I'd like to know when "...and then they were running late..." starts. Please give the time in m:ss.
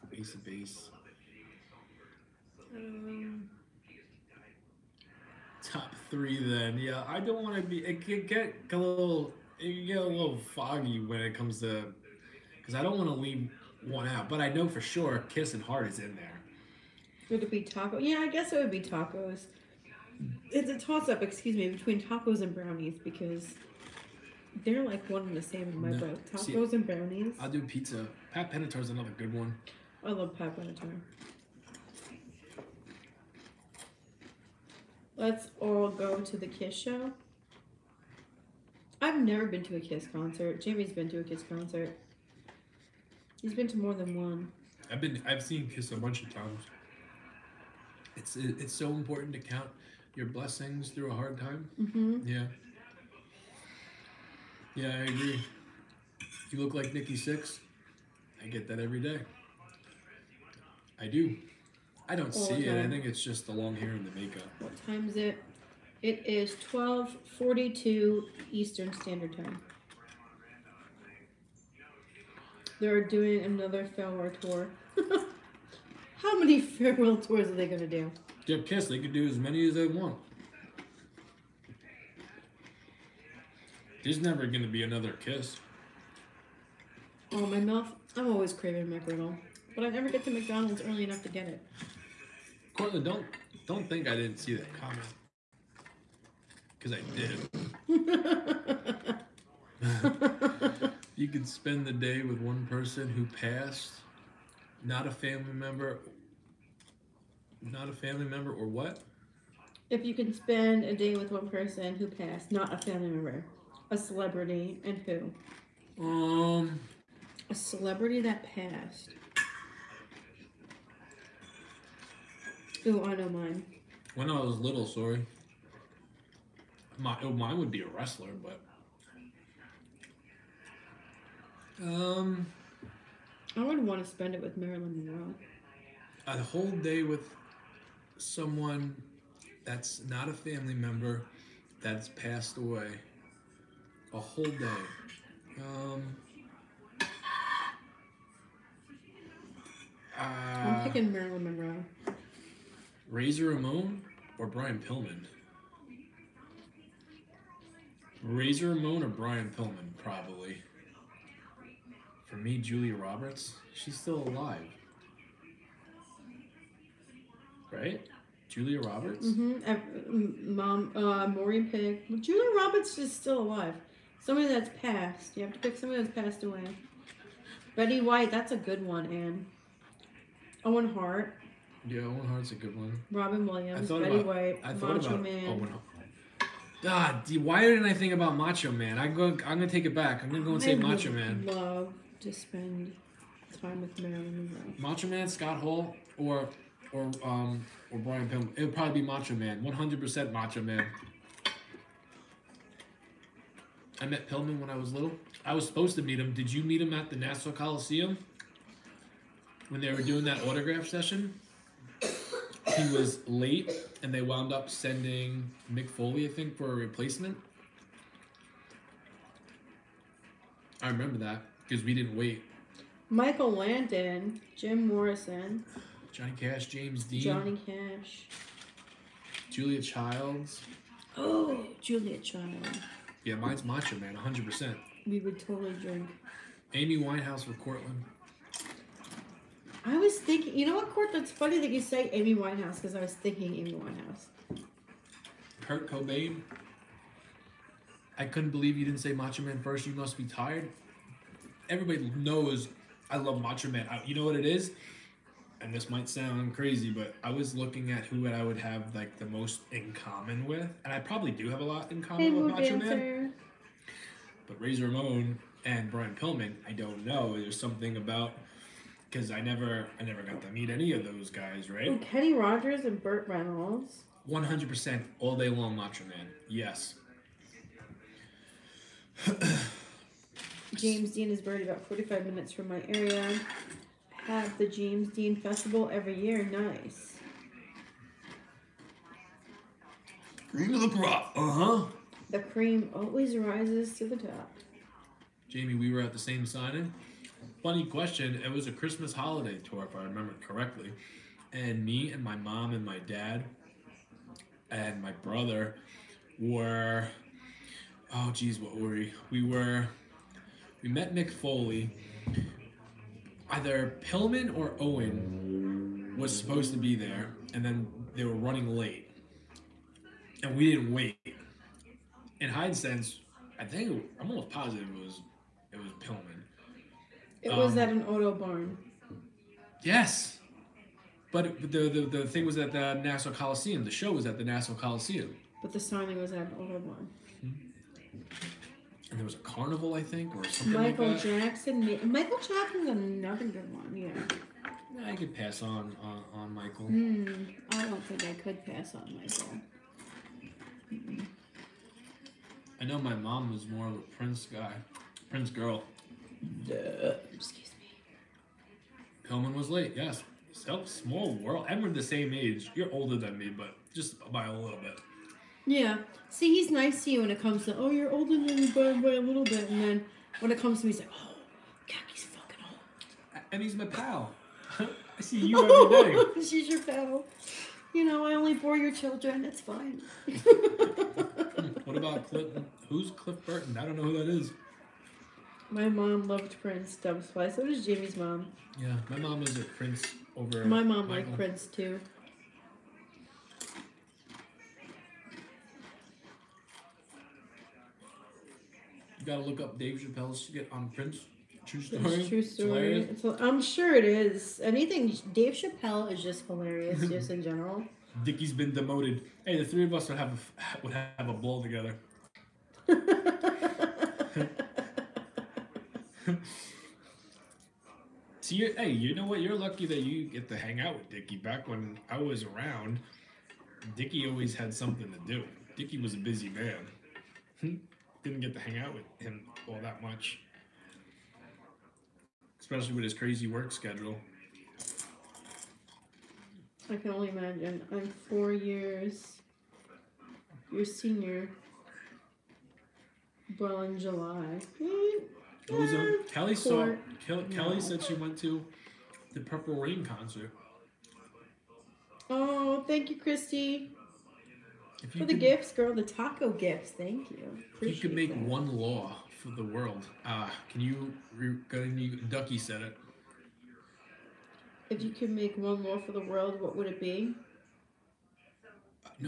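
5:17.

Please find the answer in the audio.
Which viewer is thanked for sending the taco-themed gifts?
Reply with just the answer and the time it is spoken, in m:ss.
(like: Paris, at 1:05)
Christy, at 7:33.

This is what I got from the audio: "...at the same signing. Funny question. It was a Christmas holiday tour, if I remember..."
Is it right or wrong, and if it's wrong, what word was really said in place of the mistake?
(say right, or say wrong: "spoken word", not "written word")
right.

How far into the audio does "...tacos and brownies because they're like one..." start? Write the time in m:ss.
0:22.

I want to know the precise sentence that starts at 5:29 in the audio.
Yes, but the, the the thing was at the Nassau Coliseum.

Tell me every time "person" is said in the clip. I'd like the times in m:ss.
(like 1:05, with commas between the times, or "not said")
1:42, 1:51.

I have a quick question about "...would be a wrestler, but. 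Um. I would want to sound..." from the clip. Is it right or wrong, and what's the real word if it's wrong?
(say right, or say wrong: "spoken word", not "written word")
wrong: "spend", not "sound".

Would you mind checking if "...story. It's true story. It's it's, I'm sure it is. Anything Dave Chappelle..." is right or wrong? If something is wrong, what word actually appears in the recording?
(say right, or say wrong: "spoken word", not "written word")
right.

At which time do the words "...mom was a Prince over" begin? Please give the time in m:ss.
6:29.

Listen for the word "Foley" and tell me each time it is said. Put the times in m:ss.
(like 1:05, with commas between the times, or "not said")
3:35, 5:11.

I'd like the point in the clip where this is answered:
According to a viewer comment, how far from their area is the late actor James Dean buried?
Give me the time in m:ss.
4:41.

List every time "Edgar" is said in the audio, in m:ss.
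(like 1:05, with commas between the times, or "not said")
not said.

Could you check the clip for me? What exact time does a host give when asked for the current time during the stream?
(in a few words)
12:42.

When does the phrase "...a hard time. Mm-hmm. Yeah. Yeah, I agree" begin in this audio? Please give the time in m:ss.
0:51.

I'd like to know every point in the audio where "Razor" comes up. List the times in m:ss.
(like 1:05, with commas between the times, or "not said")
2:33, 2:38, 4:24.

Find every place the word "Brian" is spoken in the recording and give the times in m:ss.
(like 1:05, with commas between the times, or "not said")
2:34, 2:39, 3:17, 4:25.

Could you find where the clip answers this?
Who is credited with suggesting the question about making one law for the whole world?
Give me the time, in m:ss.
7:42.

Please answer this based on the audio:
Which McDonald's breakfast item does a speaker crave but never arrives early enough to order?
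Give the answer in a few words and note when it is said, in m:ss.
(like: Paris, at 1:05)
McGriddle, at 1:28.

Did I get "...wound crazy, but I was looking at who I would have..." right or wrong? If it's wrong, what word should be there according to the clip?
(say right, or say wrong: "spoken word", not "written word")
wrong: "sound", not "wound".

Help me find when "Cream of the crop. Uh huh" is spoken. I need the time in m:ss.
4:50.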